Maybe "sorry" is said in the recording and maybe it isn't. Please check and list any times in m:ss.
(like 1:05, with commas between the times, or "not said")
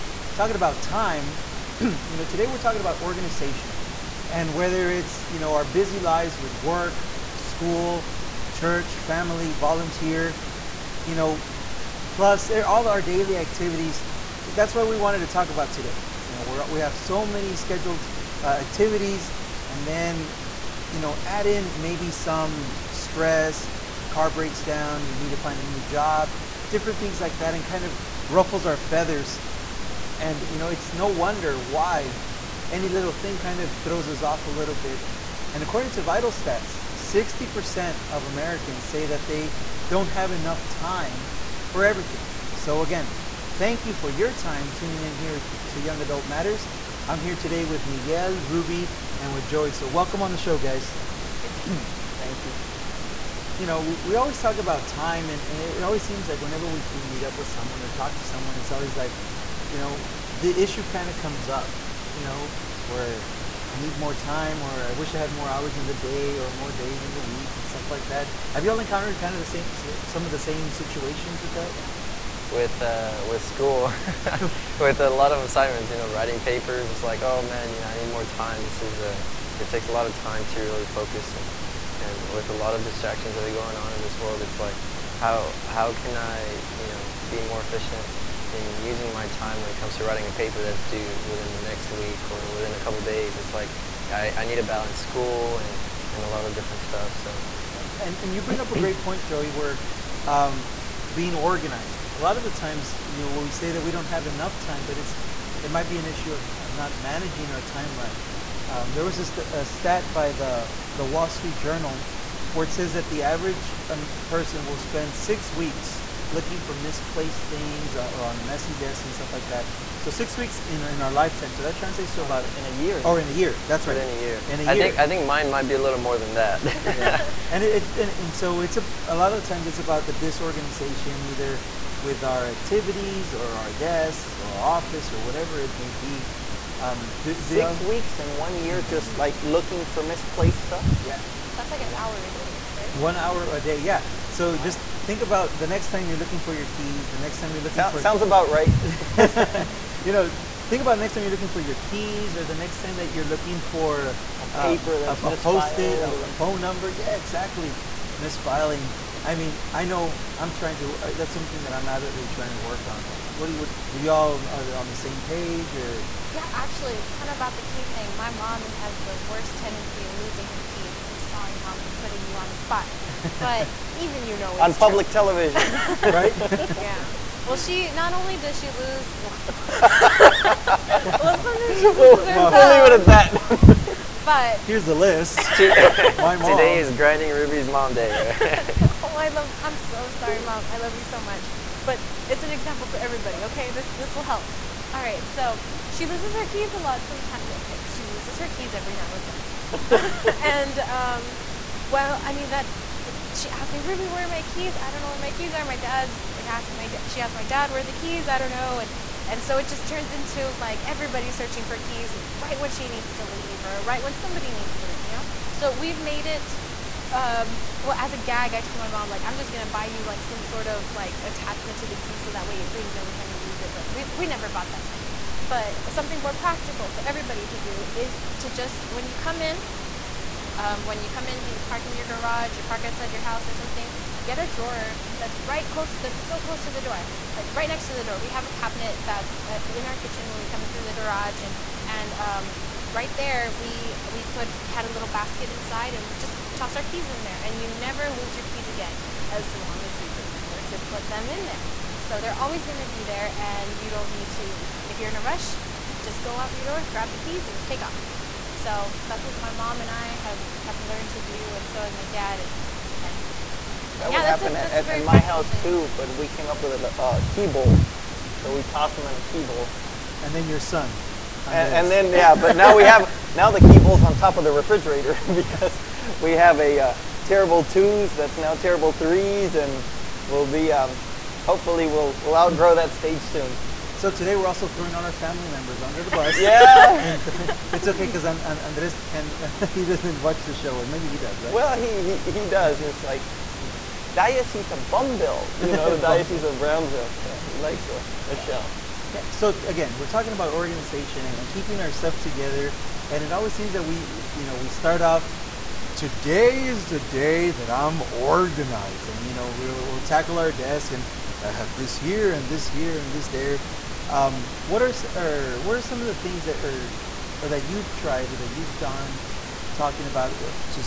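2:51, 3:10.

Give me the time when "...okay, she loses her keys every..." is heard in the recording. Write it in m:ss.
3:17.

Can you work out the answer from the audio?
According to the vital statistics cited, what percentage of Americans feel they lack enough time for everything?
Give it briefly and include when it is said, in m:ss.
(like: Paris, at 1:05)
60%, at 0:36.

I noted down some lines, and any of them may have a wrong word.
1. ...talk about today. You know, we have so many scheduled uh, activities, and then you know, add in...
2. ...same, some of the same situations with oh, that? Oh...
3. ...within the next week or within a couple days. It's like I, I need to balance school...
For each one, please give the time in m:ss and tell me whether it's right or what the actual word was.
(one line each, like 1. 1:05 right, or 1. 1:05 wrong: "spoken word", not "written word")
1. 0:15 right
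2. 1:09 right
3. 1:31 right.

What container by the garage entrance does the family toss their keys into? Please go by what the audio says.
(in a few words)
basket.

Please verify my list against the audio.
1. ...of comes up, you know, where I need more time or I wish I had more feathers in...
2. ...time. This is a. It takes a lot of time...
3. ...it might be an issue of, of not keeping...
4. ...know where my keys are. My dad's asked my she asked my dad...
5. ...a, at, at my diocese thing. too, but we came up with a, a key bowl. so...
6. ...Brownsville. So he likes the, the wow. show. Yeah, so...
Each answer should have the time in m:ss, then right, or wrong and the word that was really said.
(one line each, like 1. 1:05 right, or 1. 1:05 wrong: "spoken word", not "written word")
1. 1:01 wrong: "hours", not "feathers"
2. 1:18 right
3. 1:45 wrong: "managing", not "keeping"
4. 3:25 right
5. 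4:24 wrong: "house", not "diocese"
6. 4:56 right.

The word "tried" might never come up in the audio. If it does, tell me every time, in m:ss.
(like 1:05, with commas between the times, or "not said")
5:17.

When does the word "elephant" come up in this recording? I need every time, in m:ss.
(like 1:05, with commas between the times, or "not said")
not said.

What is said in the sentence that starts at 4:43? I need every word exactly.
So today we're also throwing all our family members under the bus.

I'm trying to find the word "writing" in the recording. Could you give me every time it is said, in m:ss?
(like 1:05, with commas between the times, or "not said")
1:16, 1:30.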